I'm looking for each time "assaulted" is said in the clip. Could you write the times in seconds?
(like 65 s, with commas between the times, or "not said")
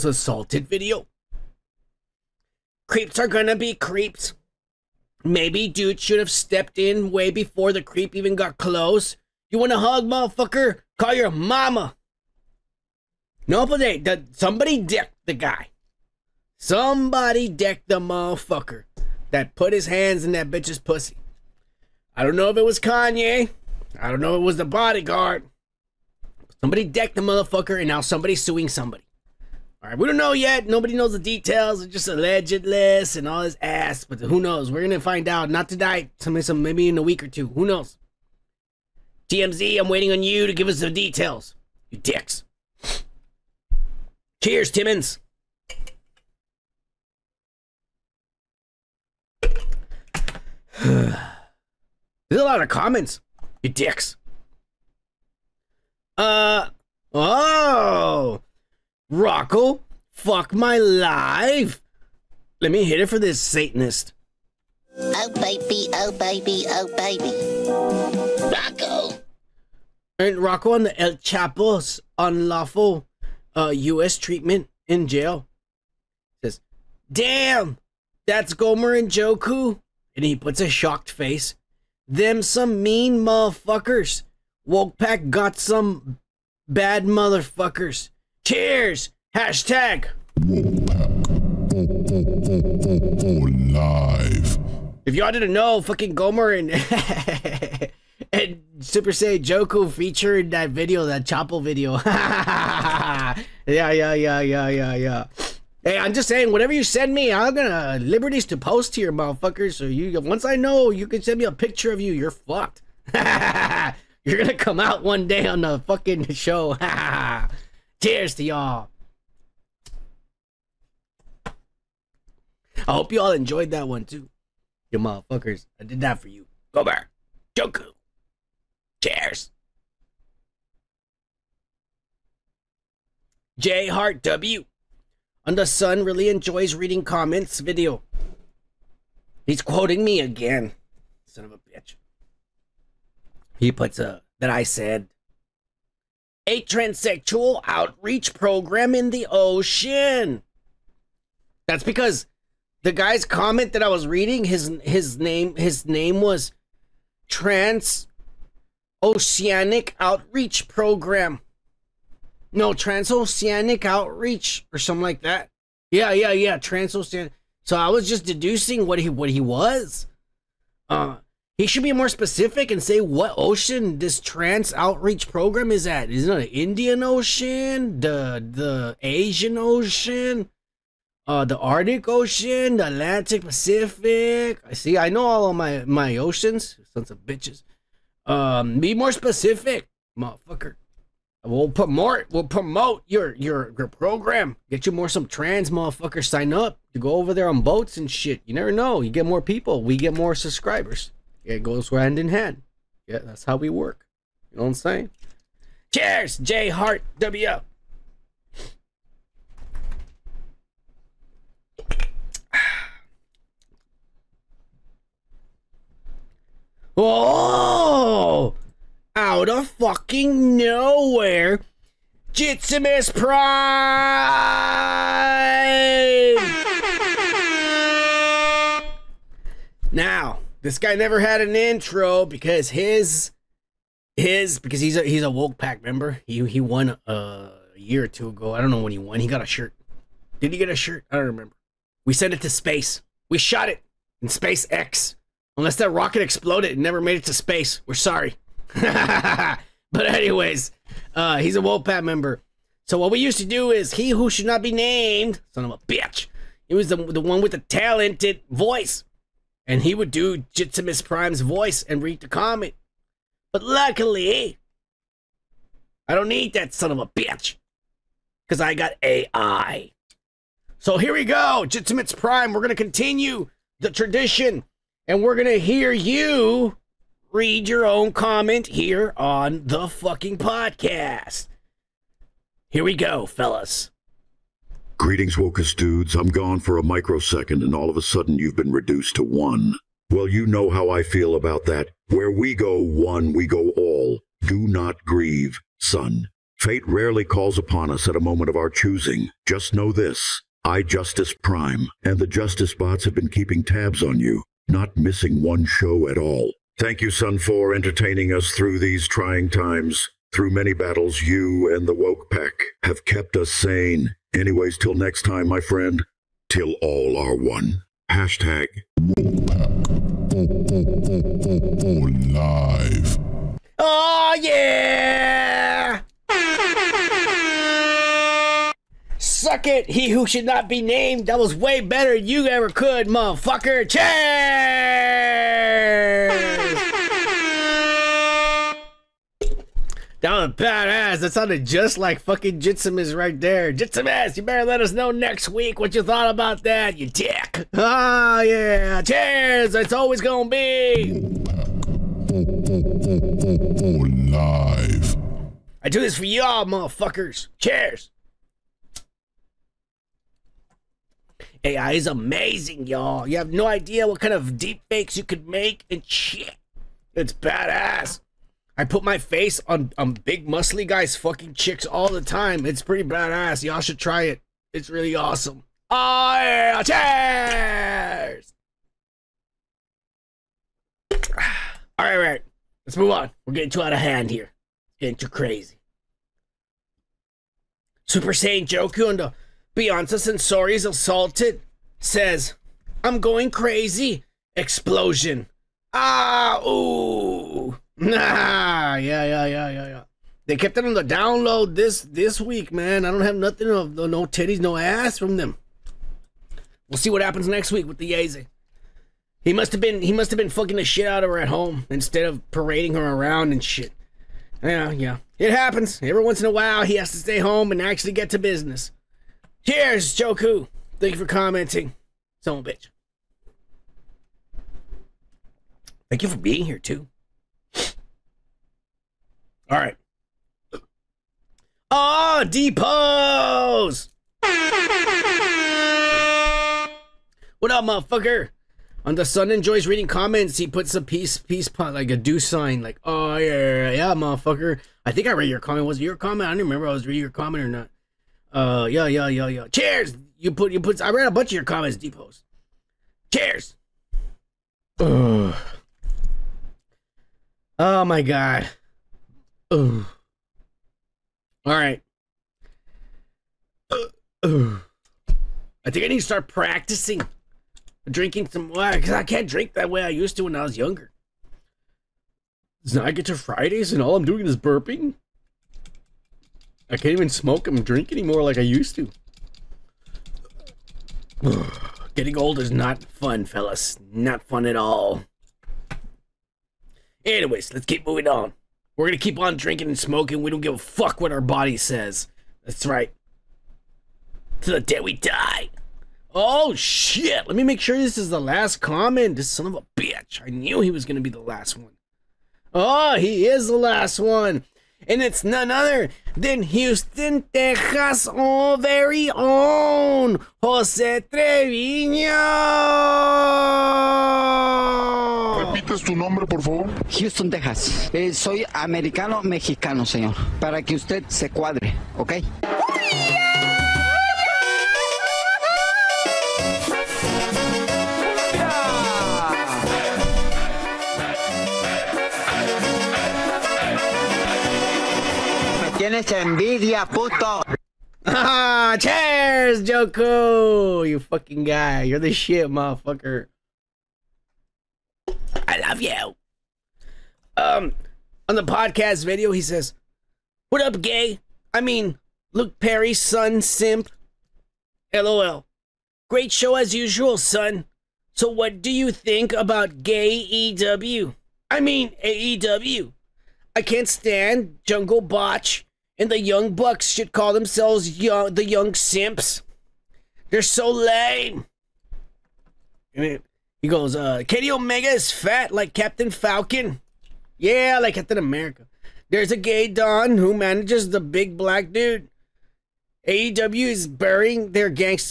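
0 s, 390 s.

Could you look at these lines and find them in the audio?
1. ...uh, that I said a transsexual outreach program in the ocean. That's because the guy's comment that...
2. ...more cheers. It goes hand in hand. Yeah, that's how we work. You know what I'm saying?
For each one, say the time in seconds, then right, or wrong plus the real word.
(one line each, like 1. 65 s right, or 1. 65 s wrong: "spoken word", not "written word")
1. 144 s right
2. 200 s wrong: "subscribers", not "cheers".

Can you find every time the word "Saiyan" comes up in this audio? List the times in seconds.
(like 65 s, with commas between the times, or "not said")
99 s, 388 s.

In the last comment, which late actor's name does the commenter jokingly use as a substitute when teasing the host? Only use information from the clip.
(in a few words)
Luke Perry.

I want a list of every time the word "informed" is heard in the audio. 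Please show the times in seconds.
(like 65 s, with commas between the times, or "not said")
not said.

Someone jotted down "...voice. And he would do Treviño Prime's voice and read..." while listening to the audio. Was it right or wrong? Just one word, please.
wrong.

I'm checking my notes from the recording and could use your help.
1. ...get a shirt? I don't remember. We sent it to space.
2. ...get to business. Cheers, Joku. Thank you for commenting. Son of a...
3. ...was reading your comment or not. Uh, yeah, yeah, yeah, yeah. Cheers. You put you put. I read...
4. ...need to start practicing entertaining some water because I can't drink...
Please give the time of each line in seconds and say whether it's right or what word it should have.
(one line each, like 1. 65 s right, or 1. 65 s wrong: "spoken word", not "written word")
1. 240 s right
2. 418 s right
3. 446 s right
4. 466 s wrong: "drinking", not "entertaining".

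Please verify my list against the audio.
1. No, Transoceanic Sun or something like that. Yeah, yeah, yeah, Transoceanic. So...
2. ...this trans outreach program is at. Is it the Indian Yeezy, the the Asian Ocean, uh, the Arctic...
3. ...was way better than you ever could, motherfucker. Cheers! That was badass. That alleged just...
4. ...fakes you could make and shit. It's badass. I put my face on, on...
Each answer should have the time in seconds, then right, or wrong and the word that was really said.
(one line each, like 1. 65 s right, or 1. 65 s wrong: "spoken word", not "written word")
1. 162 s wrong: "Outreach", not "Sun"
2. 173 s wrong: "Ocean", not "Yeezy"
3. 331 s wrong: "sounded", not "alleged"
4. 364 s right.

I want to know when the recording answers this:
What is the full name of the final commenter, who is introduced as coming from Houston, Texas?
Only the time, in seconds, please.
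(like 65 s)
510 s.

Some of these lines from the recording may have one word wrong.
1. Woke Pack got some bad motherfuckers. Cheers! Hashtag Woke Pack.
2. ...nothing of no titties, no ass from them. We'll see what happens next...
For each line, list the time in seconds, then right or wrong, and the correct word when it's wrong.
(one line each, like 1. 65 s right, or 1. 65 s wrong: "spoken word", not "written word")
1. 84 s right
2. 403 s right.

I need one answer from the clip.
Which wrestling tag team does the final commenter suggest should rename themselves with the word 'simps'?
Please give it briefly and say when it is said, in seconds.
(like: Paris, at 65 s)
Young Bucks, at 566 s.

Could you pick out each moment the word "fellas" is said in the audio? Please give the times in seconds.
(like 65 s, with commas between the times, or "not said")
283 s, 483 s.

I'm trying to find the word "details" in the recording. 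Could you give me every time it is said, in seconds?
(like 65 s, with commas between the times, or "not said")
31 s, 40 s.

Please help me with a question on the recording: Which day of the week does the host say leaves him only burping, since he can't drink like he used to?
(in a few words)
Fridays.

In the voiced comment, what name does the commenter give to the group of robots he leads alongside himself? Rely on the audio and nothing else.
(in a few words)
Justice Bots.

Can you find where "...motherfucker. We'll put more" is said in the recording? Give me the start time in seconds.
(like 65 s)
190 s.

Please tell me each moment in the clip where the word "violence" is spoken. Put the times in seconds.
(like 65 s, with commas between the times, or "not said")
not said.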